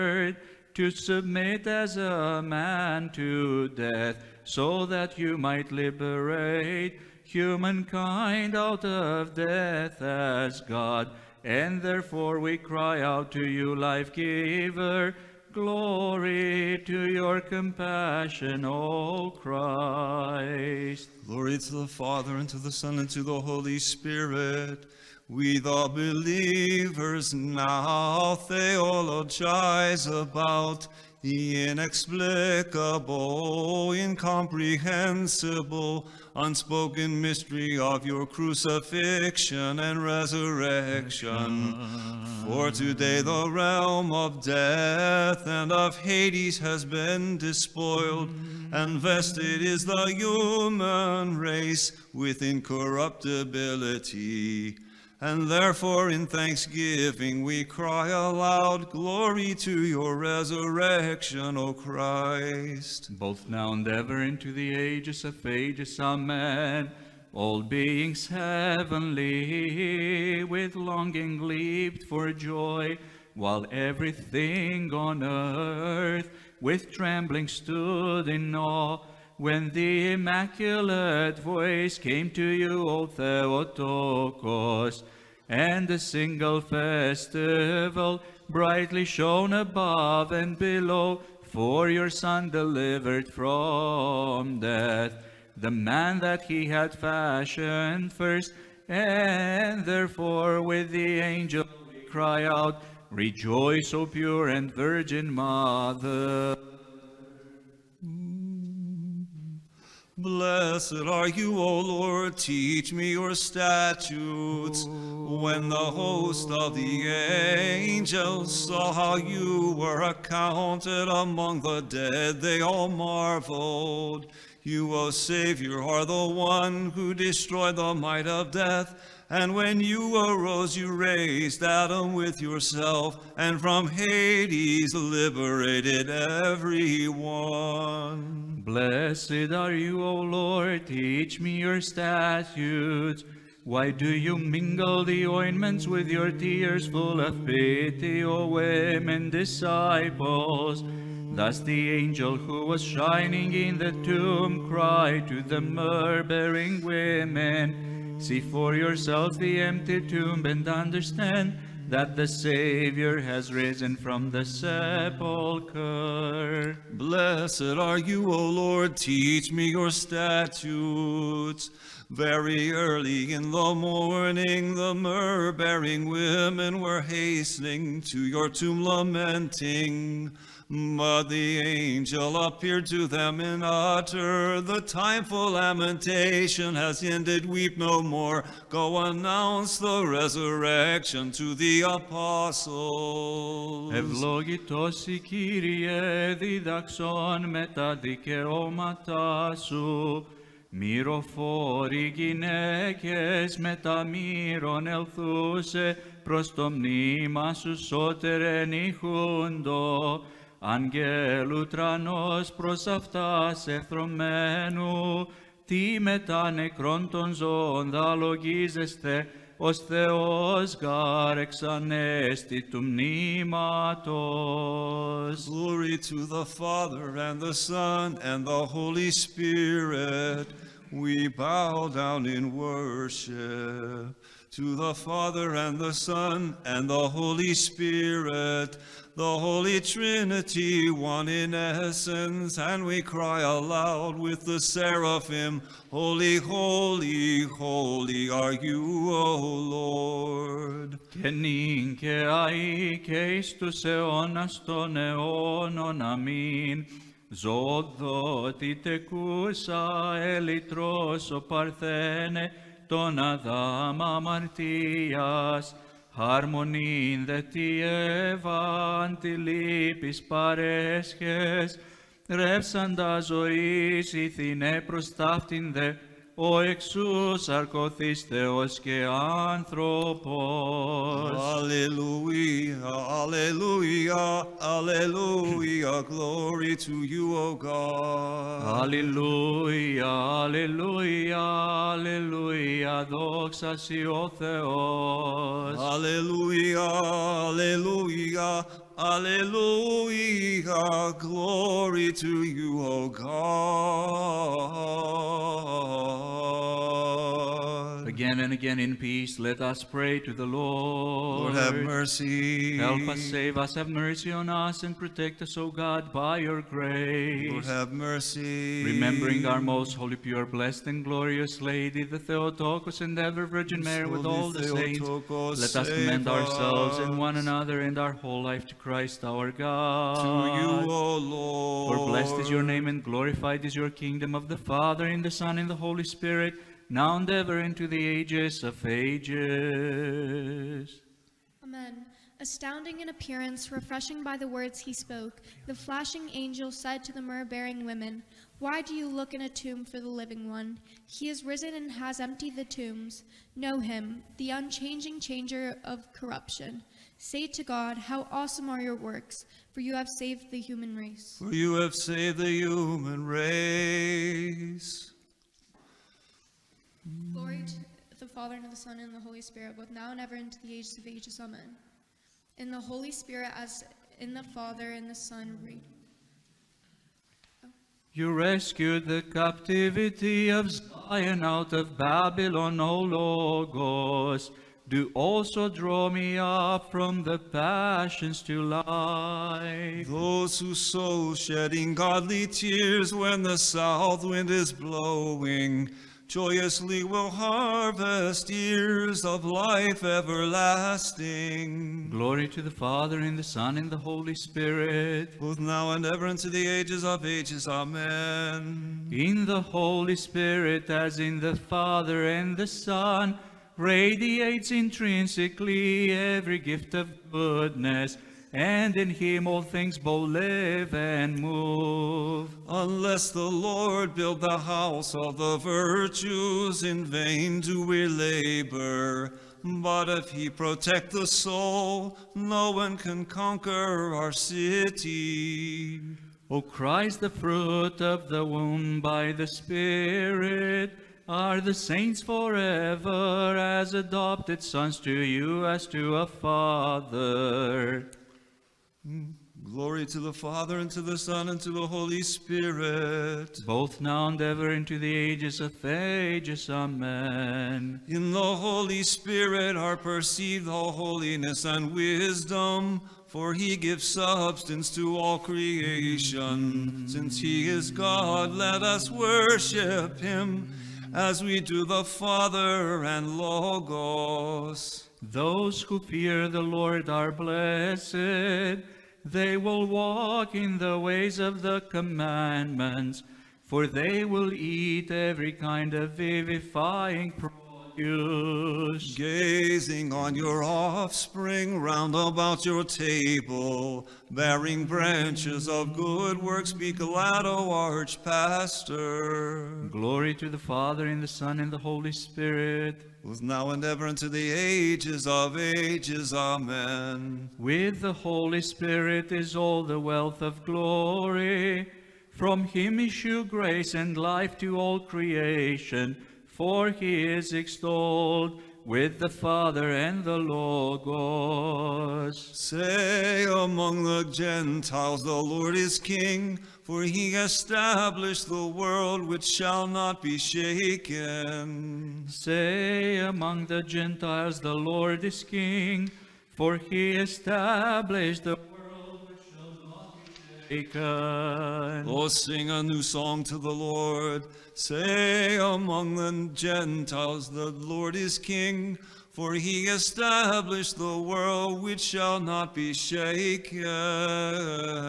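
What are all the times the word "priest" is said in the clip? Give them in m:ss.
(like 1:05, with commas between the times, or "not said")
not said.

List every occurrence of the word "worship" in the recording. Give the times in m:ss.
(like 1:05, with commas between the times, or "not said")
3:52, 7:49.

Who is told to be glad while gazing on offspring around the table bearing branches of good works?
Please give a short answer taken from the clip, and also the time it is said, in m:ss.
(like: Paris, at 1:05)
Archpastor, at 8:17.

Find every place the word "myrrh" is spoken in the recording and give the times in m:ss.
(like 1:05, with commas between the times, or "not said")
2:54, 5:47.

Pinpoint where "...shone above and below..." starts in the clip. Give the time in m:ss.
1:29.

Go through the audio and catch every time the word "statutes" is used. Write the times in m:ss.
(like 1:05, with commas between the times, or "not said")
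1:53, 2:21, 2:49.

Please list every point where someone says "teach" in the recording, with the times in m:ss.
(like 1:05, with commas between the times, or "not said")
1:52, 2:20, 2:48.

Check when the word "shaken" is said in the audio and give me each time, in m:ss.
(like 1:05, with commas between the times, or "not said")
8:50, 9:12.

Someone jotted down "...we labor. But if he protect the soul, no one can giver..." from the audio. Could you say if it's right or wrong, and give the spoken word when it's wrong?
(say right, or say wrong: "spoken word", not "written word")
wrong: "conquer", not "giver".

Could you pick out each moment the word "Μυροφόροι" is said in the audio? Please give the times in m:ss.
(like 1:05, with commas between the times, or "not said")
3:20.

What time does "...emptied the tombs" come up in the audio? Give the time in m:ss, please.
5:52.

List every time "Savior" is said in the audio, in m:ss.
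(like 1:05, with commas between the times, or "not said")
2:05, 2:42.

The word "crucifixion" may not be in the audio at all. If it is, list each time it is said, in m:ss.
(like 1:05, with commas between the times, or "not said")
0:38.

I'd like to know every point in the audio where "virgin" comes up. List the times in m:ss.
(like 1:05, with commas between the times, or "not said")
1:44, 5:23.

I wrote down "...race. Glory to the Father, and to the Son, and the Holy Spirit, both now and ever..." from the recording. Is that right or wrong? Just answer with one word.
right.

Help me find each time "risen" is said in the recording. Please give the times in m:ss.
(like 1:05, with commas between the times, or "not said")
2:43, 5:51.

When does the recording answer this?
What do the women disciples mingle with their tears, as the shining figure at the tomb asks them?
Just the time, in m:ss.
2:25.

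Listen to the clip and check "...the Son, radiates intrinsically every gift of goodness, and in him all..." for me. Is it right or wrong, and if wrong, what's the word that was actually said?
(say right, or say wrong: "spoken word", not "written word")
right.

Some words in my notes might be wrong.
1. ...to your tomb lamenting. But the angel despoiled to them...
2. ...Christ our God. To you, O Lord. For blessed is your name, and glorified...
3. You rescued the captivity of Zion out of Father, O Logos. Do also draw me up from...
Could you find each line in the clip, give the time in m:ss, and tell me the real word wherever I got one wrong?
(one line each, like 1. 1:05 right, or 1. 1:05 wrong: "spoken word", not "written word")
1. 2:58 wrong: "appeared", not "despoiled"
2. 5:28 right
3. 6:18 wrong: "Babylon", not "Father".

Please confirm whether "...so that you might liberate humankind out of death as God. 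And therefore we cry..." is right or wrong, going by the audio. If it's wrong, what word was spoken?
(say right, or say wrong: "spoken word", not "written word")
right.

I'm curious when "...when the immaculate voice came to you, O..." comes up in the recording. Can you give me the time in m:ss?
1:19.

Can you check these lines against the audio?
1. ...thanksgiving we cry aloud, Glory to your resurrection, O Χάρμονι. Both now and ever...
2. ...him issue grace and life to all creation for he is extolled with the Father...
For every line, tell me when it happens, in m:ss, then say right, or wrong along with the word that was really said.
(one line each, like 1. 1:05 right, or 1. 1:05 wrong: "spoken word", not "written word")
1. 0:56 wrong: "Christ", not "Χάρμονι"
2. 8:32 right.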